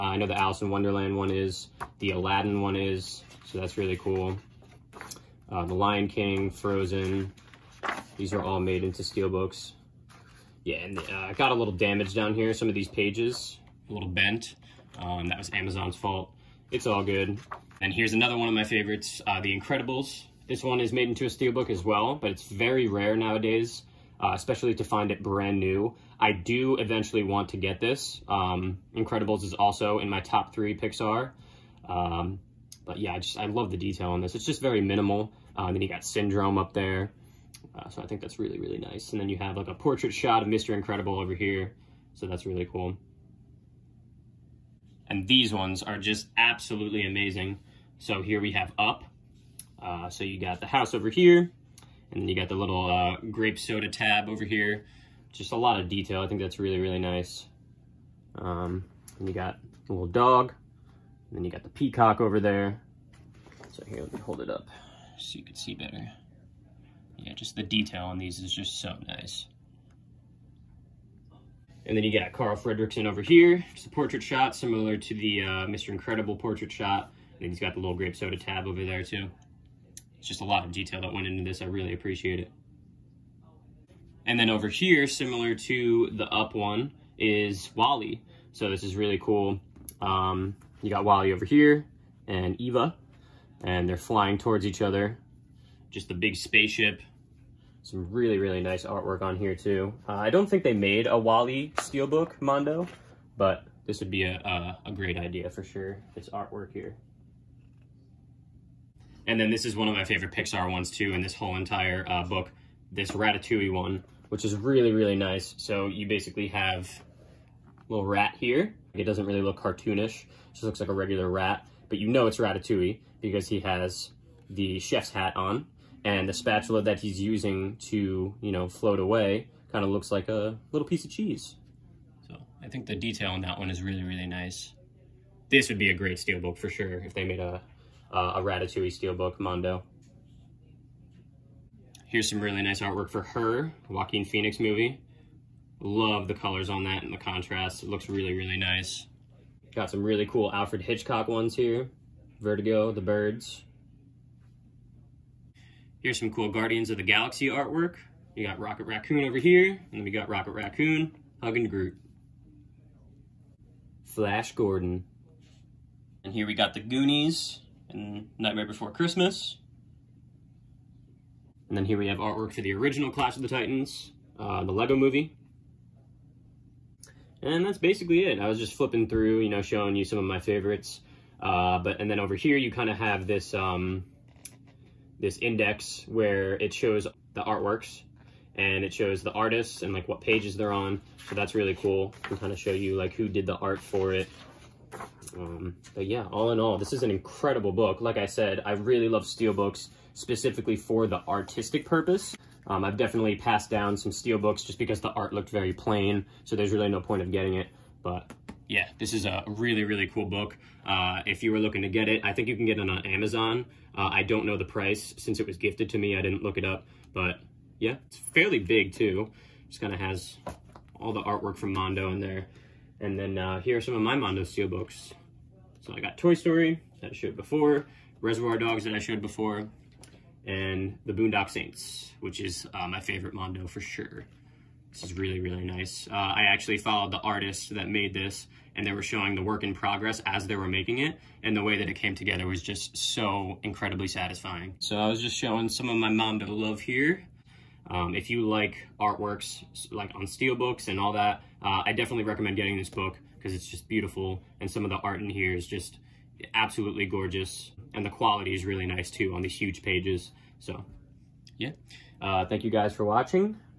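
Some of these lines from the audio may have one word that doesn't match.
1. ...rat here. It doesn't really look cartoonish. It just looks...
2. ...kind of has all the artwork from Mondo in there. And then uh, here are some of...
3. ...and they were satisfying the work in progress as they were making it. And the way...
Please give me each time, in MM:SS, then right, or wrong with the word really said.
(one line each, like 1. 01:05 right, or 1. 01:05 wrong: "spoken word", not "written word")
1. 01:58 right
2. 03:39 right
3. 03:58 wrong: "showing", not "satisfying".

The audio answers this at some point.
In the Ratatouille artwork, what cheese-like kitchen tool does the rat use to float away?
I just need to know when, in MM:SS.
02:06.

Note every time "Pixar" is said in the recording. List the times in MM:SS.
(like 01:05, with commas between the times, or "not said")
00:30, 01:50.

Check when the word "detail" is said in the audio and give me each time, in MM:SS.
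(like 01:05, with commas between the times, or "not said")
00:33, 00:55, 01:07, 01:20, 02:12.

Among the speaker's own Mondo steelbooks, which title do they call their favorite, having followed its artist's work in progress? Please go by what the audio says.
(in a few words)
The Boondock Saints.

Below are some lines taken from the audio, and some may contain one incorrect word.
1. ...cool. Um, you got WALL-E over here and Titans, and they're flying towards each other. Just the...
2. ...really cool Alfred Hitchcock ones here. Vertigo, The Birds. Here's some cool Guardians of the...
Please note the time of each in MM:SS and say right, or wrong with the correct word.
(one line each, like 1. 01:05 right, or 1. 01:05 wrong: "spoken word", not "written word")
1. 01:29 wrong: "Eva", not "Titans"
2. 02:30 right.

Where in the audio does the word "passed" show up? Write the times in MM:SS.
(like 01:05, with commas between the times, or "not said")
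03:23.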